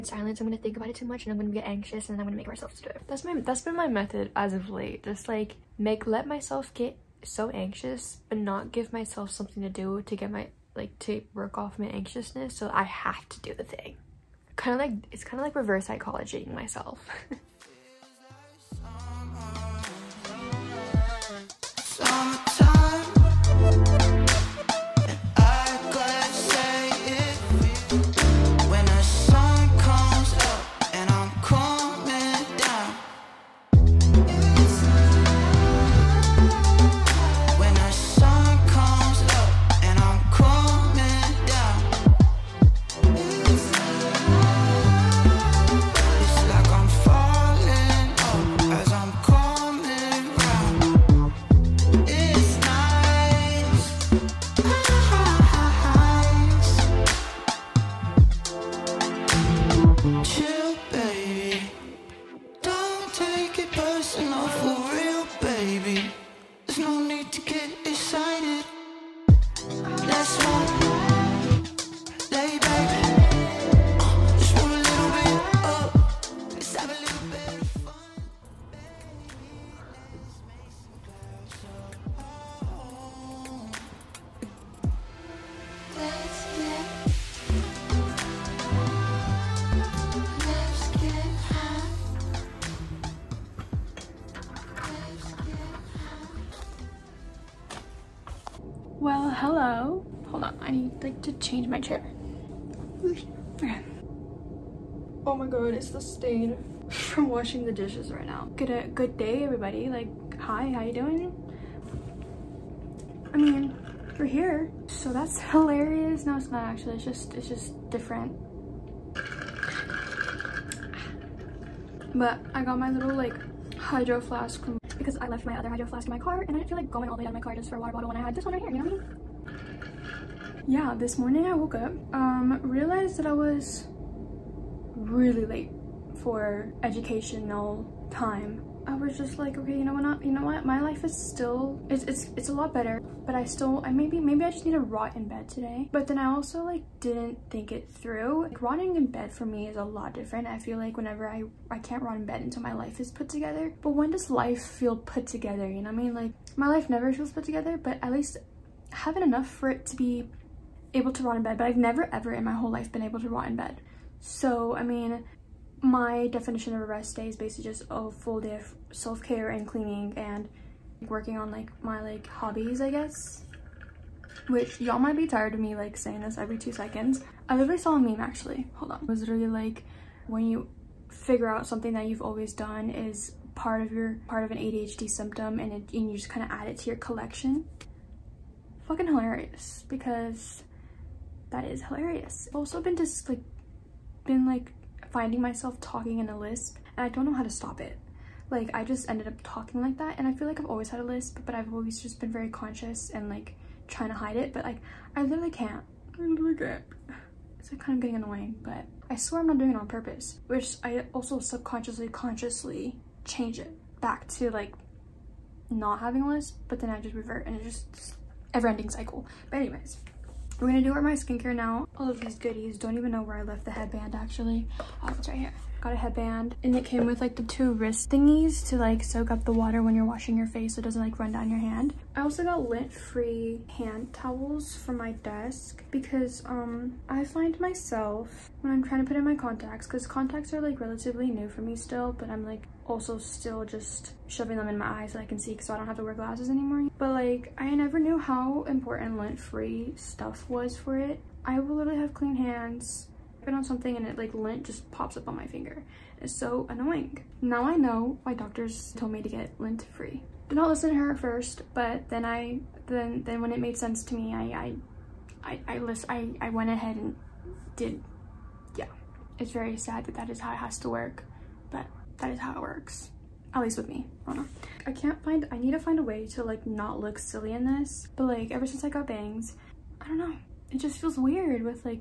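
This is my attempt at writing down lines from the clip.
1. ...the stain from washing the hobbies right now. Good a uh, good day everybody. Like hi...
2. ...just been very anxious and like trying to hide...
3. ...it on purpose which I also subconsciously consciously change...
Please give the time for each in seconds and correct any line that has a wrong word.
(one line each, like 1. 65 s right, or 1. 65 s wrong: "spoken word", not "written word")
1. 105 s wrong: "dishes", not "hobbies"
2. 202 s wrong: "conscious", not "anxious"
3. 209 s right.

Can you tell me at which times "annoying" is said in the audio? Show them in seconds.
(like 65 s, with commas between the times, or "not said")
208 s, 256 s.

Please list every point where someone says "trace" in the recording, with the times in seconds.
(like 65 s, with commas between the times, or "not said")
not said.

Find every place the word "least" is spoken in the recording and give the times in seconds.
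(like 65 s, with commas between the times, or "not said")
158 s, 273 s.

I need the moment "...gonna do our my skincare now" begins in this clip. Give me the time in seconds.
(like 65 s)
220 s.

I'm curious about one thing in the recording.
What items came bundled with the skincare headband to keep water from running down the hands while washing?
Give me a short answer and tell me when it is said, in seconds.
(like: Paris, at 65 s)
wrist thingies, at 227 s.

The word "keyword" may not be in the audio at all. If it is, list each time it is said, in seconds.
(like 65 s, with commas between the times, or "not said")
not said.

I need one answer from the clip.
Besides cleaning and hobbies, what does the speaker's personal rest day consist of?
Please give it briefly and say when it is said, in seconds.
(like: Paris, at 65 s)
self-care, at 168 s.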